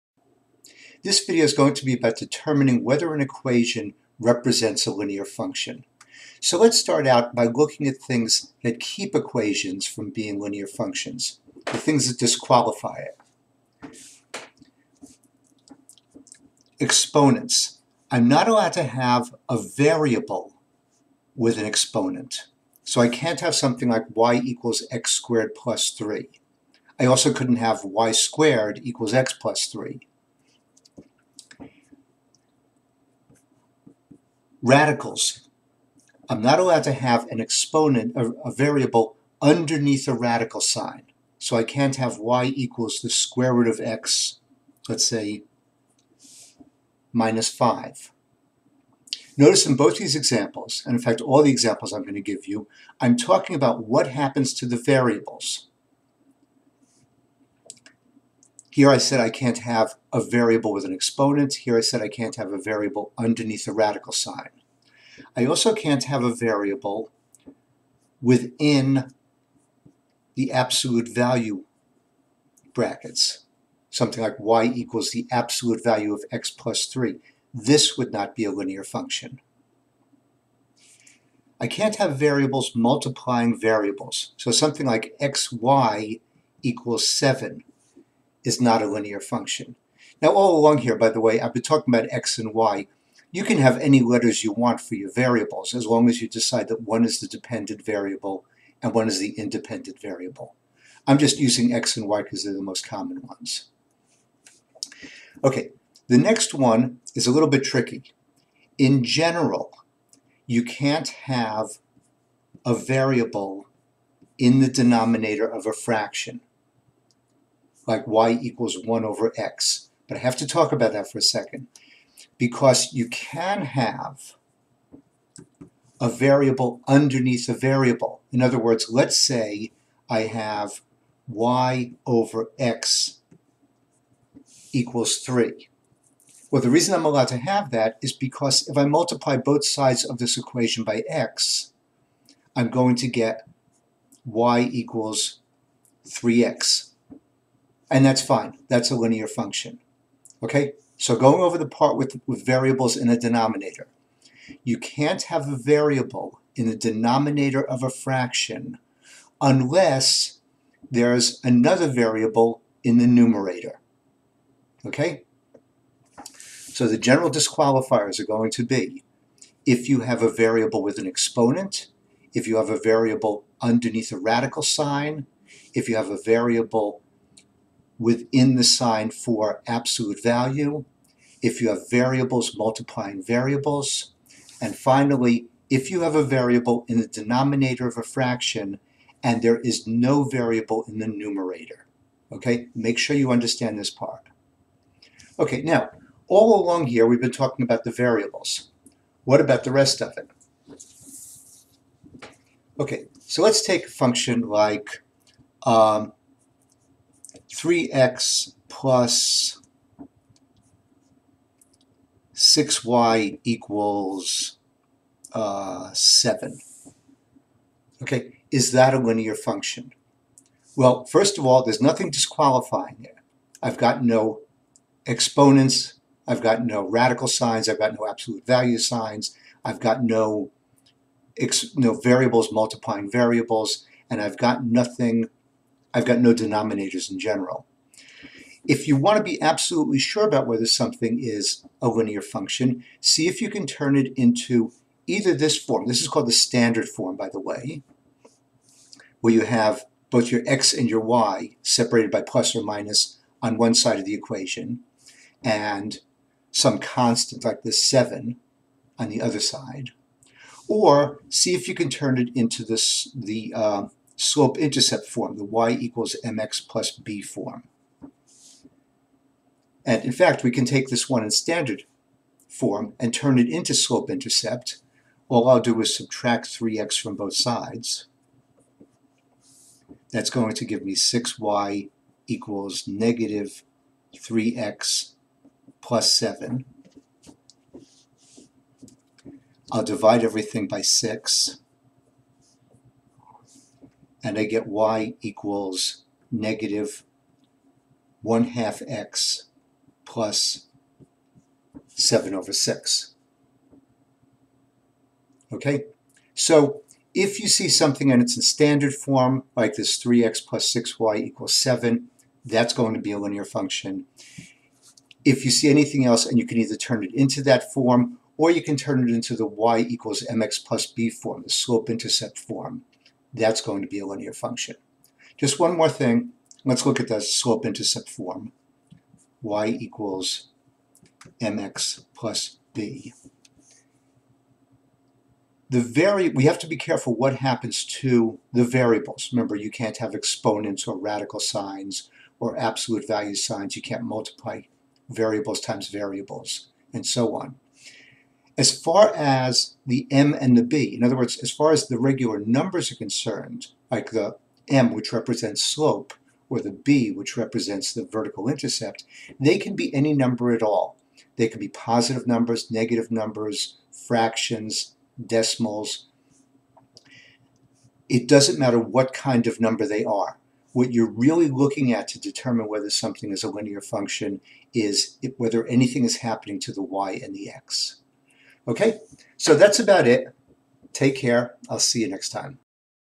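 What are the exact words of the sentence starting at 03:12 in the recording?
Okay, make sure you understand this part.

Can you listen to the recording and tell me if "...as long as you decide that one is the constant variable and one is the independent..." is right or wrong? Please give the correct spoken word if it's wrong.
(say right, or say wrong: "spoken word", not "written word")
wrong: "dependent", not "constant".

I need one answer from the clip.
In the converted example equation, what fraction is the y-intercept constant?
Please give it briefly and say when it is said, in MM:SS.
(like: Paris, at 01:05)
7/6, at 05:01.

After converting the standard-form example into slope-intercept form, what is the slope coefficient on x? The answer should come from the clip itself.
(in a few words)
-1/2.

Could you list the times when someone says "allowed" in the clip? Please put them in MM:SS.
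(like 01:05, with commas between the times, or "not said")
00:18, 00:36, 02:17.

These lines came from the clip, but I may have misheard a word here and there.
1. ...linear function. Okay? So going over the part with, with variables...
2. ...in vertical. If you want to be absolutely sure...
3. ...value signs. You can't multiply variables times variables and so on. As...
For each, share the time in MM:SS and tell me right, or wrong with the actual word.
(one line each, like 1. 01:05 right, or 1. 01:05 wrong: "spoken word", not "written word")
1. 02:28 right
2. 03:57 wrong: "general", not "vertical"
3. 05:43 right.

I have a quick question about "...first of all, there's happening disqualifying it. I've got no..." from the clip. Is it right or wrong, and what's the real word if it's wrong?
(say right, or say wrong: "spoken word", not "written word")
wrong: "nothing", not "happening".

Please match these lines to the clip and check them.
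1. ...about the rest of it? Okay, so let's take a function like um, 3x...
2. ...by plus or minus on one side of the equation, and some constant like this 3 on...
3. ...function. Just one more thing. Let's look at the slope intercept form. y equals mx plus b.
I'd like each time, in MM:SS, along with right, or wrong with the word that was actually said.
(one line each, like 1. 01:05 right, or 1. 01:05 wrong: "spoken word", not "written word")
1. 03:19 right
2. 04:12 wrong: "7", not "3"
3. 05:24 right.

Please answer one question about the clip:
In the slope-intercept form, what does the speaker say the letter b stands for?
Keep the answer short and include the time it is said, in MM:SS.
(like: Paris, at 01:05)
vertical intercept, at 05:58.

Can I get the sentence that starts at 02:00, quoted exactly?
But I have to talk about that for a second because you can have a variable underneath a variable.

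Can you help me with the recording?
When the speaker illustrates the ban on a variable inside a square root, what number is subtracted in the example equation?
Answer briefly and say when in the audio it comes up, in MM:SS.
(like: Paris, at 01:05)
5, at 00:47.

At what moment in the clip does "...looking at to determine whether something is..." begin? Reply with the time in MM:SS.
06:11.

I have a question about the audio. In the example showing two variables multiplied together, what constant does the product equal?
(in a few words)
7.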